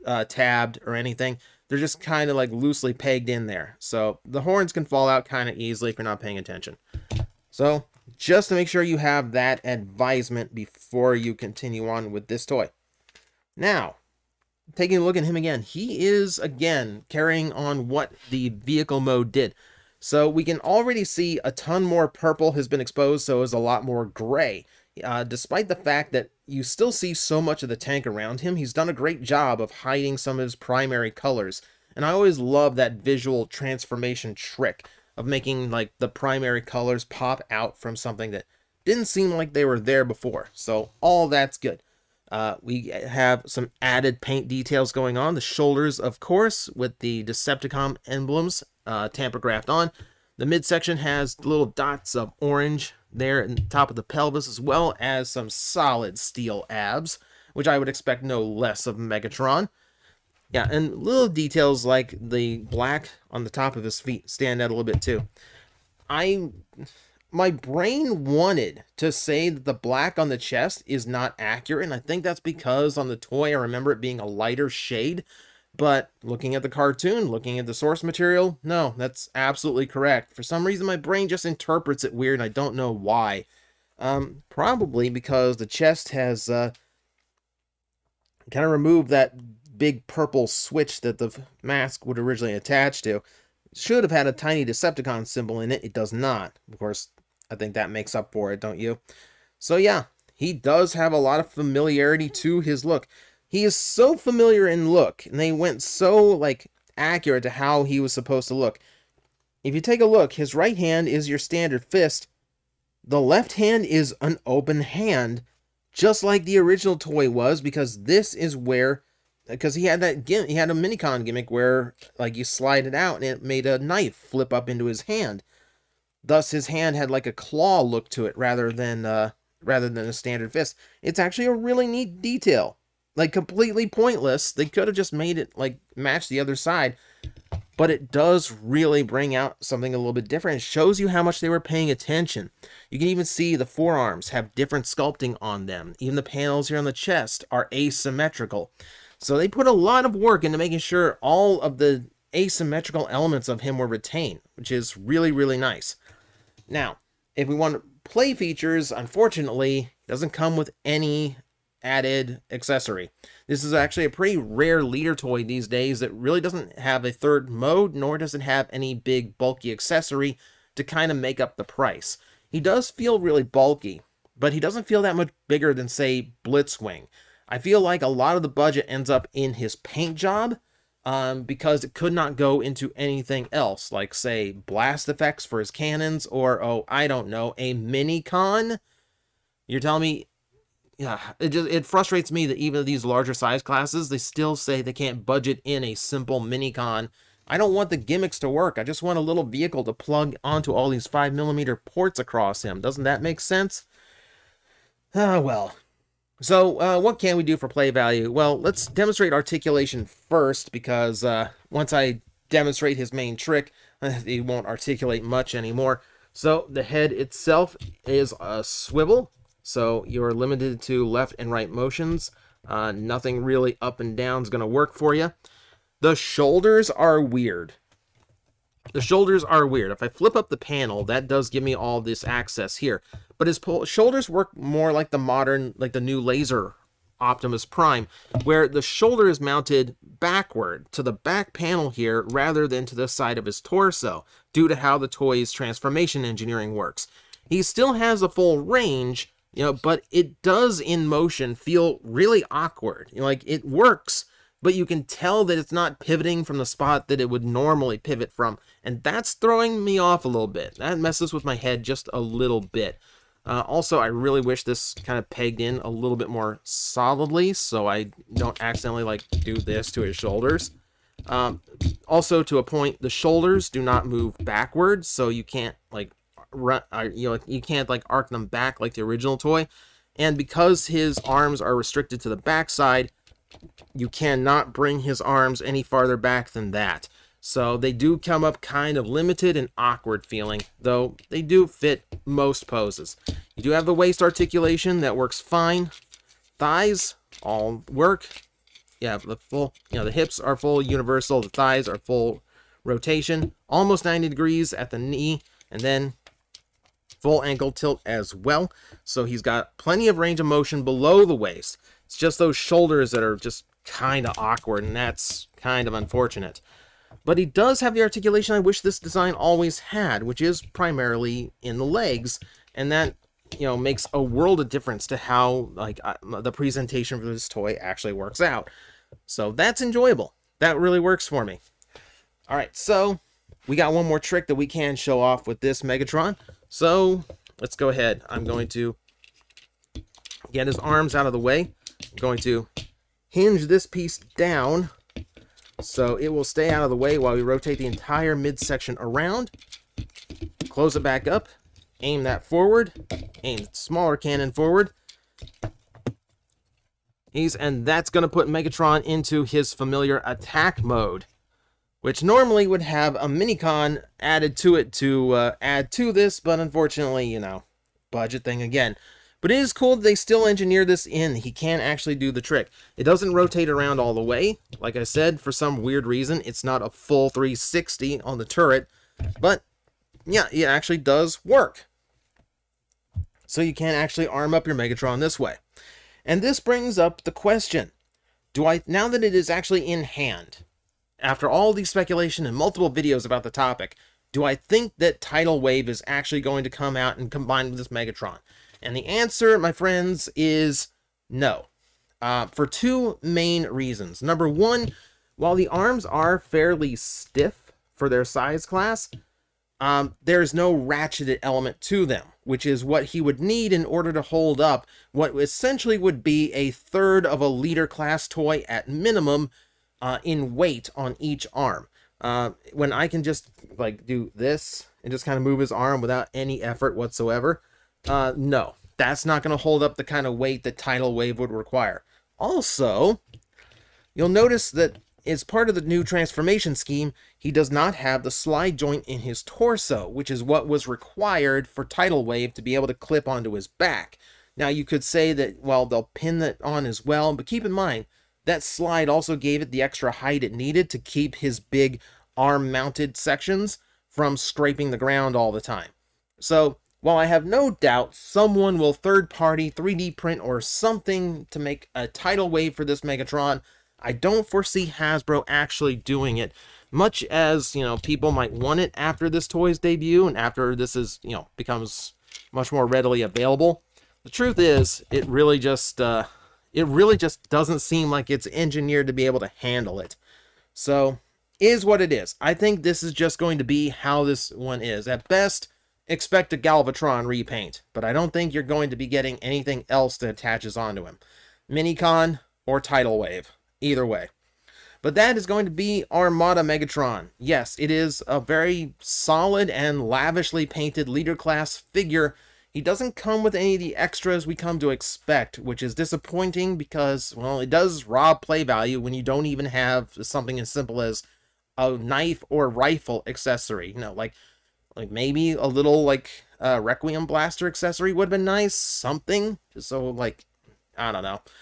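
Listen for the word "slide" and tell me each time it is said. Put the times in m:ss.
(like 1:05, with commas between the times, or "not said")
2:02, 7:18, 7:28.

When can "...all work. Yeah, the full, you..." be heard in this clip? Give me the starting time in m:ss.
4:57.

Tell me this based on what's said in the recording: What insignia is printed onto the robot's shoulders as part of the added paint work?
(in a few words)
Decepticon emblems.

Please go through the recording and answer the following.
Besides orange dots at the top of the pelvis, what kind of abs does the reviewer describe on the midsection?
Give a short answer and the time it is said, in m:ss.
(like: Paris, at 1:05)
solid steel, at 0:55.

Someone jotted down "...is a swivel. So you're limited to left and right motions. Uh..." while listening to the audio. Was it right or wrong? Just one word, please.
right.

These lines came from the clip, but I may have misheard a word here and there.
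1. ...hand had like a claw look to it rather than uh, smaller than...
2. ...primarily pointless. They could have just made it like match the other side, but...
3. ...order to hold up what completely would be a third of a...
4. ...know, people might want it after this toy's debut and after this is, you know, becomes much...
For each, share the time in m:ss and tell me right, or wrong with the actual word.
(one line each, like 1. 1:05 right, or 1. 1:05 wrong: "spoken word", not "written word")
1. 2:06 wrong: "rather", not "smaller"
2. 2:13 wrong: "completely", not "primarily"
3. 6:53 wrong: "essentially", not "completely"
4. 7:47 right.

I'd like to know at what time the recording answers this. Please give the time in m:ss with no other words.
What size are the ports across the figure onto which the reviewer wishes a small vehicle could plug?
3:21.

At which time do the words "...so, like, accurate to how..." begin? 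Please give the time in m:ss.
1:45.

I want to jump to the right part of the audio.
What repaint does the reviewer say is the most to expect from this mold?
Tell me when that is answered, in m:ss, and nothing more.
8:06.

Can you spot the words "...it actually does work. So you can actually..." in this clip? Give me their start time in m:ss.
6:20.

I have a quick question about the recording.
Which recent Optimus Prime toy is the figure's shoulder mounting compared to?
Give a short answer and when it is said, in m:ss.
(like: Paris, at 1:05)
laser Optimus Prime, at 3:56.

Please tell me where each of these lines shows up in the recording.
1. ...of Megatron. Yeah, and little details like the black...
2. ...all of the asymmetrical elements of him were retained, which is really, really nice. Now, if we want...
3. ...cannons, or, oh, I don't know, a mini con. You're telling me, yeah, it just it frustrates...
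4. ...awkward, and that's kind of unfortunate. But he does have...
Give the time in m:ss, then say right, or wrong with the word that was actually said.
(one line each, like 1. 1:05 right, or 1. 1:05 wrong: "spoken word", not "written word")
1. 0:58 right
2. 2:31 right
3. 3:05 right
4. 5:14 right.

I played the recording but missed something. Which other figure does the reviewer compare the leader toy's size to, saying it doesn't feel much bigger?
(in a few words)
Blitzwing.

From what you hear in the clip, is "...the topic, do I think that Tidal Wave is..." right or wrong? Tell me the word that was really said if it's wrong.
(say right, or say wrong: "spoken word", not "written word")
right.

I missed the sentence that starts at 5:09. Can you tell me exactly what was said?
So he's got plenty of range of motion below the waist.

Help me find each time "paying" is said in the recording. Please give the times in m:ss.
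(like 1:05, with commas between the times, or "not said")
0:06, 2:21.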